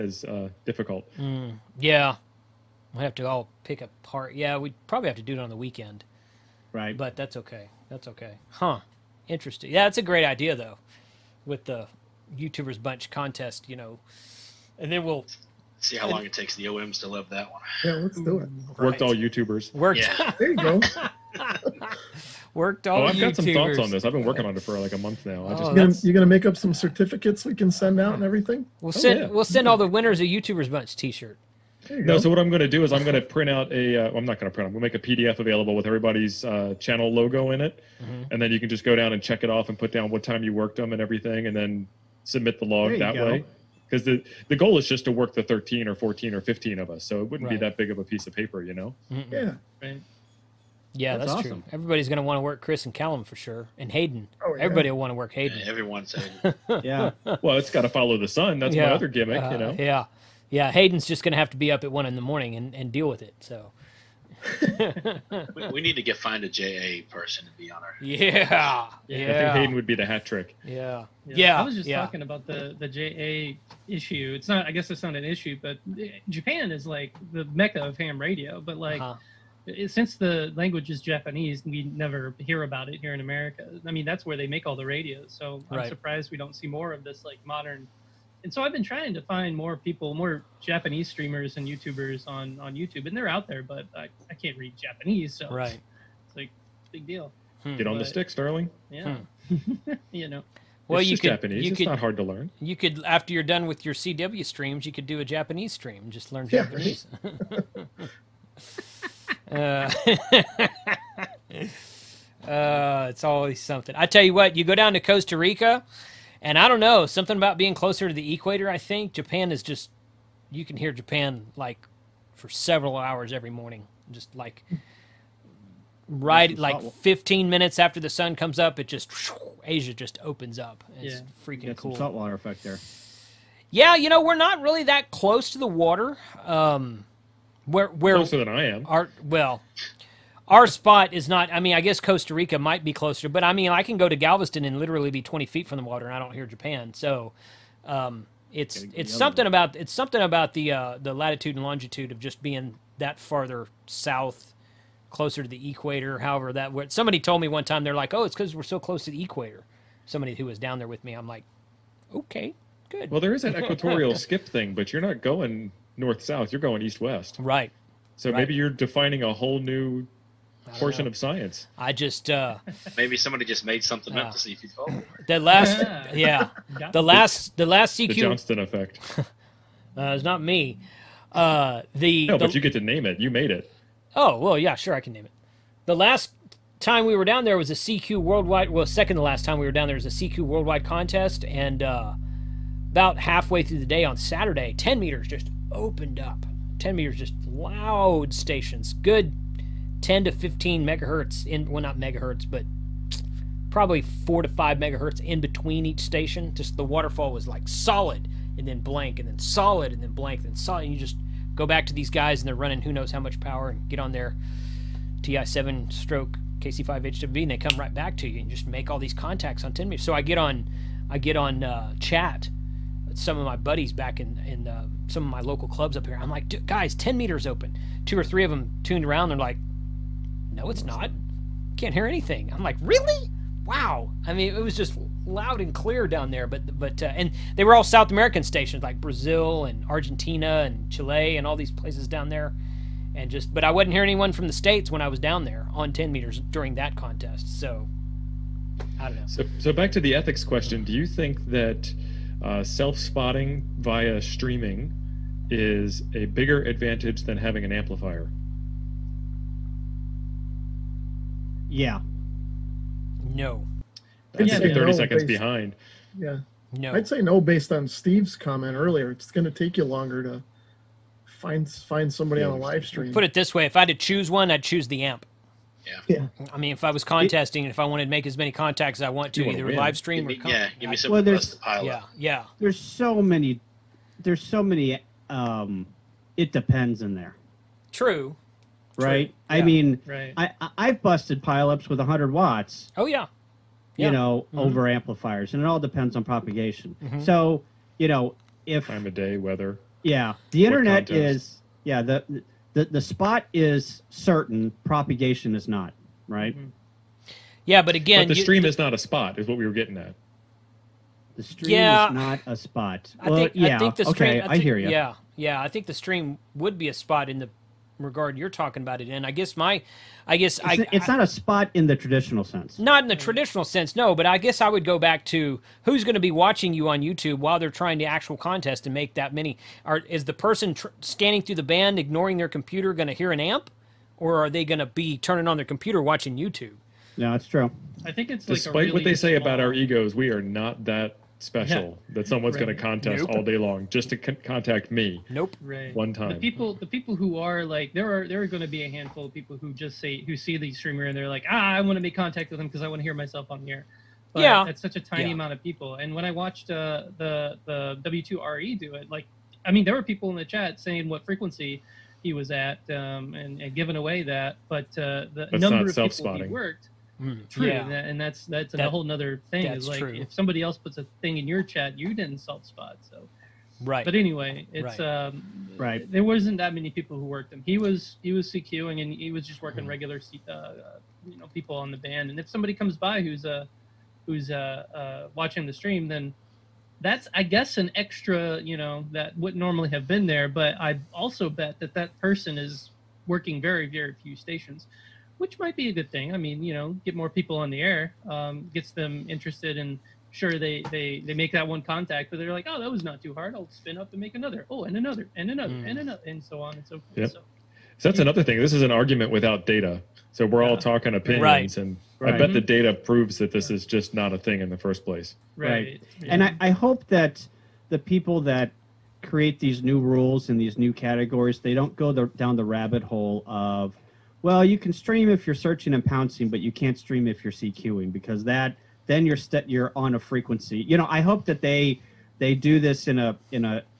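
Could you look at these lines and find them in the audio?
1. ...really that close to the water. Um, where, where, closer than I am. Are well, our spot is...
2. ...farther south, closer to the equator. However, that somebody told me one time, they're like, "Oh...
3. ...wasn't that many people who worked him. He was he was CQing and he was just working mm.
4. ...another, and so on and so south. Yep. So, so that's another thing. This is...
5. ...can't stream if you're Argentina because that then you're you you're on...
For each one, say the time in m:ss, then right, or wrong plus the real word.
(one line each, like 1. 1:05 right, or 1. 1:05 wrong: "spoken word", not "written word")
1. 2:14 right
2. 2:33 right
3. 6:16 right
4. 6:45 wrong: "forth", not "south"
5. 7:06 wrong: "CQing", not "Argentina".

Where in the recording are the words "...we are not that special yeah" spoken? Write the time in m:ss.
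5:40.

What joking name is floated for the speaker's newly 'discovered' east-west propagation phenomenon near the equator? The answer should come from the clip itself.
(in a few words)
The Johnston effect.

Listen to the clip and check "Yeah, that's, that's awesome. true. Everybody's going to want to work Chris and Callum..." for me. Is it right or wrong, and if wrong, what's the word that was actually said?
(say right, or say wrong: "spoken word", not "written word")
right.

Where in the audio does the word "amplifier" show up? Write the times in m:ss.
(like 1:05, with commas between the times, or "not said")
4:17, 4:54.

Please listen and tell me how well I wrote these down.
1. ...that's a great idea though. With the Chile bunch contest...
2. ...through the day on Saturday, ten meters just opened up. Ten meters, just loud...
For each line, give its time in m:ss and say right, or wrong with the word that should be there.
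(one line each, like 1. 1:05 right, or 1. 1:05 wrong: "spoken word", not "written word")
1. 0:09 wrong: "YouTubers", not "Chile"
2. 3:13 right.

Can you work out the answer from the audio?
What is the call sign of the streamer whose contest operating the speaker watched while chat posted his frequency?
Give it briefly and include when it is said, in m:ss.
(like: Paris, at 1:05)
W2RE, at 5:58.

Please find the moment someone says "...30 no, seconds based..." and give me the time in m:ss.
4:24.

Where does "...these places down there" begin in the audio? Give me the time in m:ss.
4:01.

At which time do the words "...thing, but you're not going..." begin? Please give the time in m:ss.
2:44.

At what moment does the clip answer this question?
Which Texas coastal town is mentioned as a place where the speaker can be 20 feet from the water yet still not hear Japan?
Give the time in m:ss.
2:24.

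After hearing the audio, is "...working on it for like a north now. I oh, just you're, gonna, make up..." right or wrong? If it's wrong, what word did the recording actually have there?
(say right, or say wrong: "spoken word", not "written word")
wrong: "month", not "north".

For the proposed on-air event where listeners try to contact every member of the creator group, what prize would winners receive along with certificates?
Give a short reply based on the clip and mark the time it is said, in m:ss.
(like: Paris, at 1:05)
T-shirt, at 0:30.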